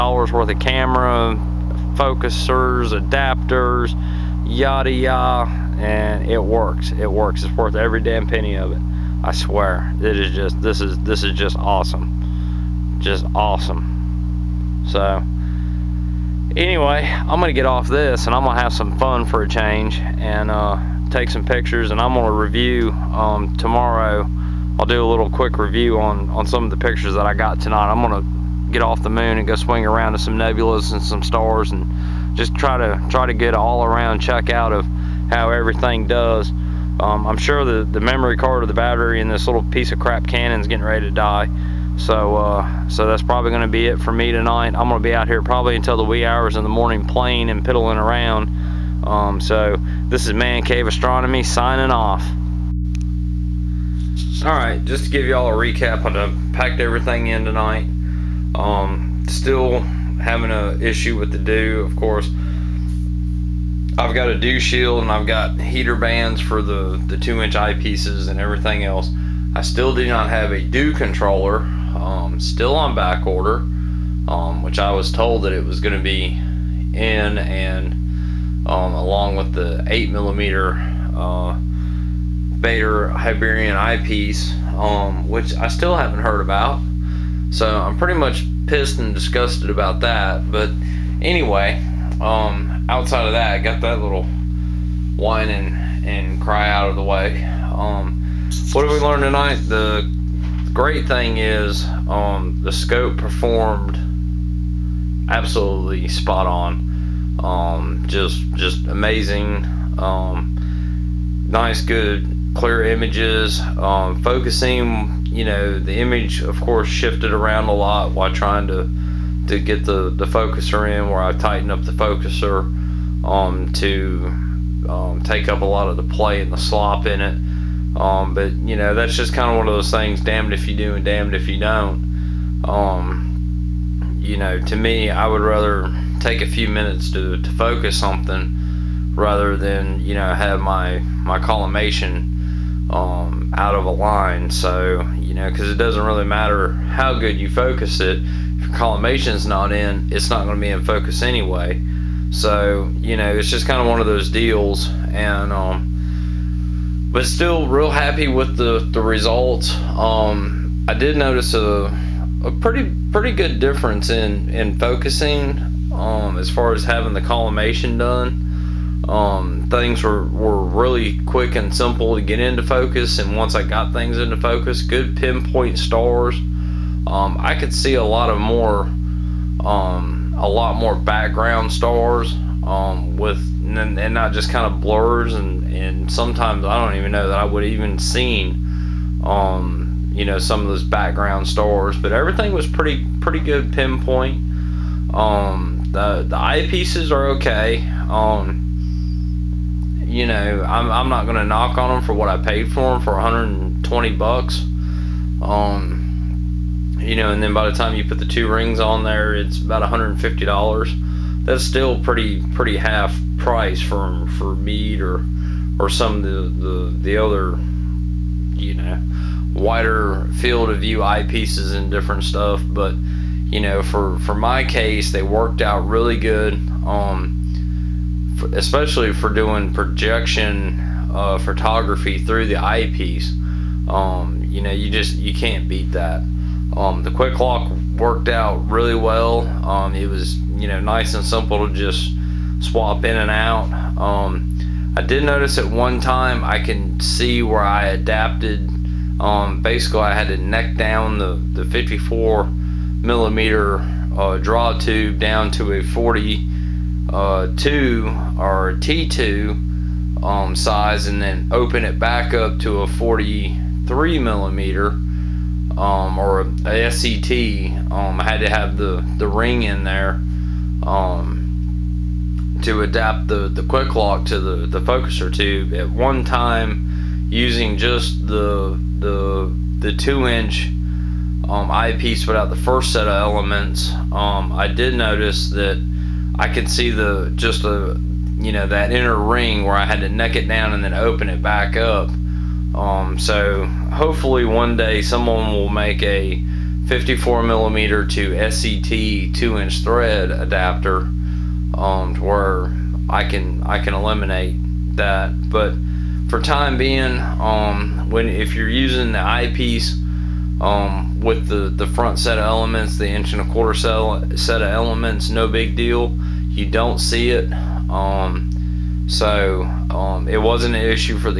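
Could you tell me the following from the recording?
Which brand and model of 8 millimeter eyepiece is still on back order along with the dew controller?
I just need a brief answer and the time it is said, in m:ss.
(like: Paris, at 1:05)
Baader Hyperion, at 1:22.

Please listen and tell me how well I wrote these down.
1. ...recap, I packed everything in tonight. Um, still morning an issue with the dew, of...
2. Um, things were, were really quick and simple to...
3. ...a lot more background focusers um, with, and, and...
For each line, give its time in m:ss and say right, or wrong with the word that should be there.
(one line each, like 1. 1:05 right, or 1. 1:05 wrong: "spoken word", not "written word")
1. 0:55 wrong: "having", not "morning"
2. 2:49 right
3. 3:00 wrong: "stars", not "focusers".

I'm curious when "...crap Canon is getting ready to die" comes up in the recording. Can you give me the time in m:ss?
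0:39.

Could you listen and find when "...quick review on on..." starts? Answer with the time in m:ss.
0:25.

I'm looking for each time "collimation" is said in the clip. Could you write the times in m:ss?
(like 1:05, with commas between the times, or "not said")
2:21, 2:28, 2:47.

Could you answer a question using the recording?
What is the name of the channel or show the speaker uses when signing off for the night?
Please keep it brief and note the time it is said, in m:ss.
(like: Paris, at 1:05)
Man Cave Astronomy, at 0:50.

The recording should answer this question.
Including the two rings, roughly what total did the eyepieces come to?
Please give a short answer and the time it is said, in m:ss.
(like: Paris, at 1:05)
$150, at 3:29.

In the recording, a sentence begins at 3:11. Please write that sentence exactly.
But everything was pretty pretty good pinpoint.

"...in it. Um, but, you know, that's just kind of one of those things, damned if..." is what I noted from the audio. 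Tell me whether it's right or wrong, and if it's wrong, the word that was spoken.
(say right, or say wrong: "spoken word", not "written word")
right.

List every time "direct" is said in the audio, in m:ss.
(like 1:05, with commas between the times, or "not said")
not said.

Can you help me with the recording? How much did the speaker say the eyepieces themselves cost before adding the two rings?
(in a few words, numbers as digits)
$120.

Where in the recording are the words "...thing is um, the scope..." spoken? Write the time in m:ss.
1:41.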